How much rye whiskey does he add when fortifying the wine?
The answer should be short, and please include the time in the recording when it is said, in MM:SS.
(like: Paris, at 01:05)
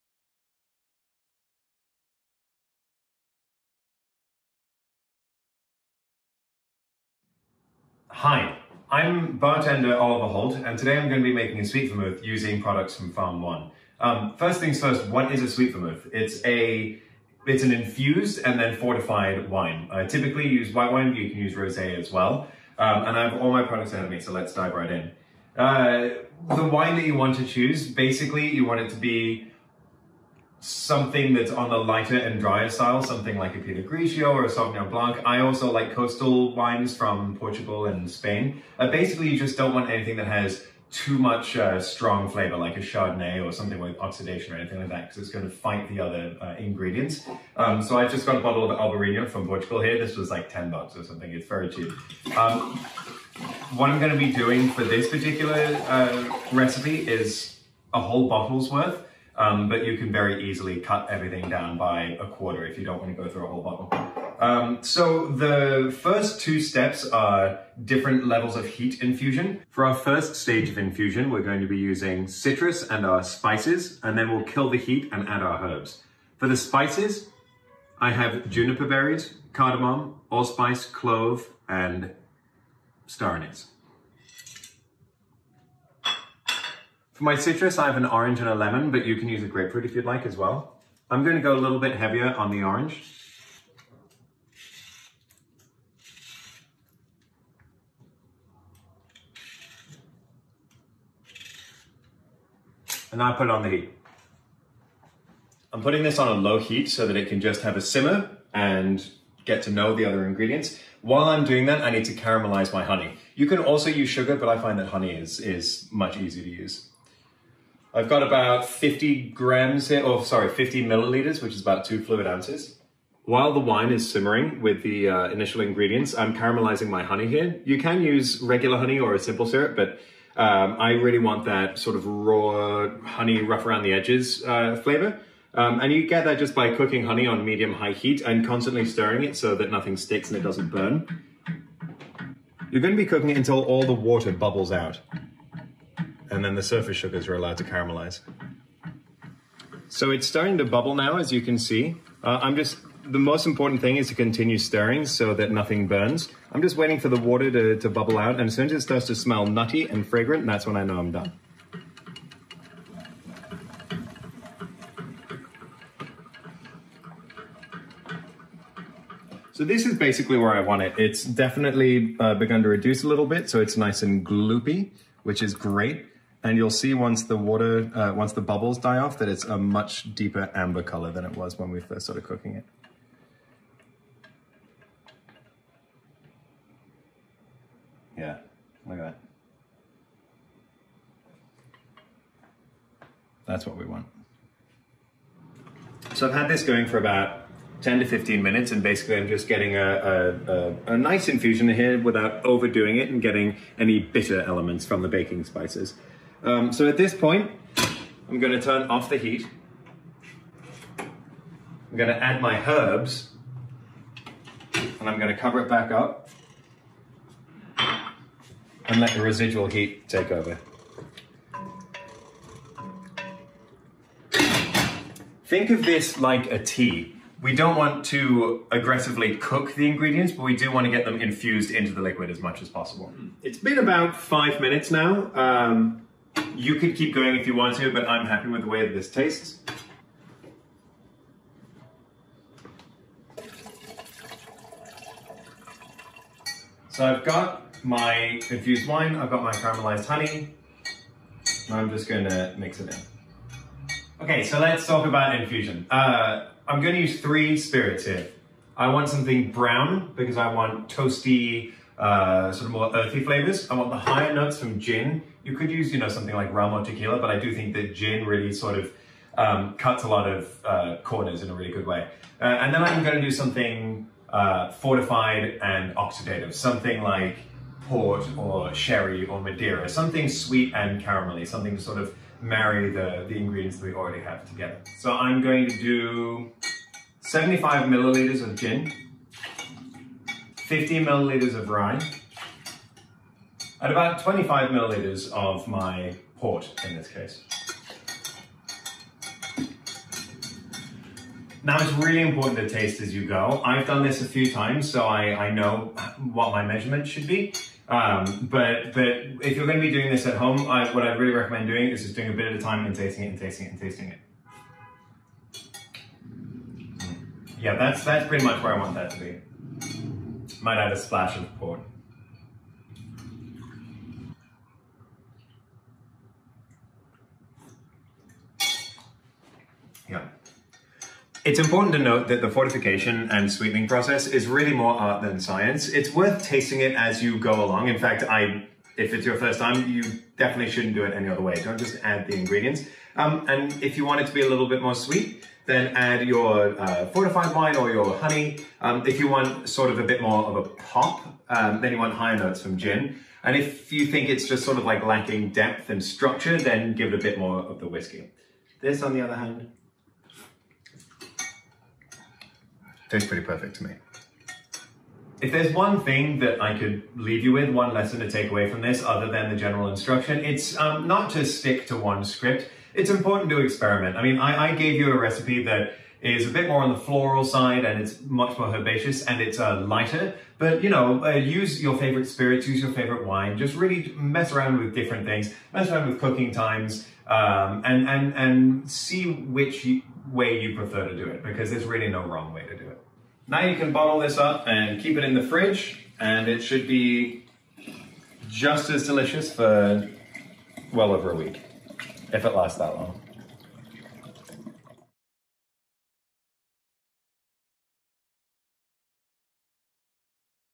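15 milliliters, at 04:50.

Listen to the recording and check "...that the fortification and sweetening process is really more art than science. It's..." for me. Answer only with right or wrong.
right.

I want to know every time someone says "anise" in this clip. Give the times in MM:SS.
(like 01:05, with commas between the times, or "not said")
01:23.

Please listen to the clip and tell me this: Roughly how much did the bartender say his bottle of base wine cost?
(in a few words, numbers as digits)
10 bucks.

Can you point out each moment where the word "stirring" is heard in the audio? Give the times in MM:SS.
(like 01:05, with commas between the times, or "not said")
02:18, 02:34.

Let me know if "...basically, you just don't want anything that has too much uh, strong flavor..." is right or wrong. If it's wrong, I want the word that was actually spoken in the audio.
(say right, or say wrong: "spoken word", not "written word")
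right.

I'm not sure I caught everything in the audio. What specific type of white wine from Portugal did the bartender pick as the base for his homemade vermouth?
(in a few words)
Albarino.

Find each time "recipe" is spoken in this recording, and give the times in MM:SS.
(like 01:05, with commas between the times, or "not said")
00:56, 06:15.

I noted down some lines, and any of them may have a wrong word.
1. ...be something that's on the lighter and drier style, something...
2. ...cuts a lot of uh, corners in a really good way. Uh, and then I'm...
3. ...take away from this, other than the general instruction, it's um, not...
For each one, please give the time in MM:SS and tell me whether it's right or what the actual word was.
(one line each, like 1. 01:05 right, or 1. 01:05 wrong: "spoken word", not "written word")
1. 00:28 right
2. 04:29 right
3. 06:08 right.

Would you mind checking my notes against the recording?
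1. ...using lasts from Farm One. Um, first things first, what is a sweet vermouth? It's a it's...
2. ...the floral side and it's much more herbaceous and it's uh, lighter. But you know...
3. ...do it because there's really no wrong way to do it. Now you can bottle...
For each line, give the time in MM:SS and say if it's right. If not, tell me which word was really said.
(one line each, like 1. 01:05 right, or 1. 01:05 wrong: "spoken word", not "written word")
1. 00:12 wrong: "products", not "lasts"
2. 06:16 right
3. 06:31 right.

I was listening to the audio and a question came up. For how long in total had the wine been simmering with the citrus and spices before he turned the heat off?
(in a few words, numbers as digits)
10 to 15 minutes.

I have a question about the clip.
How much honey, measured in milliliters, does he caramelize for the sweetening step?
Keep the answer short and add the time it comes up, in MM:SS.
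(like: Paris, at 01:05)
50 milliliters, at 02:00.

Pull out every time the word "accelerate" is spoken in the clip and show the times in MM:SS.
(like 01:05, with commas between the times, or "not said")
not said.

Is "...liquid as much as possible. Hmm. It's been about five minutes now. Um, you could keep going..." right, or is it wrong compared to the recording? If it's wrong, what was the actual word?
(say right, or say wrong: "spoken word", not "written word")
right.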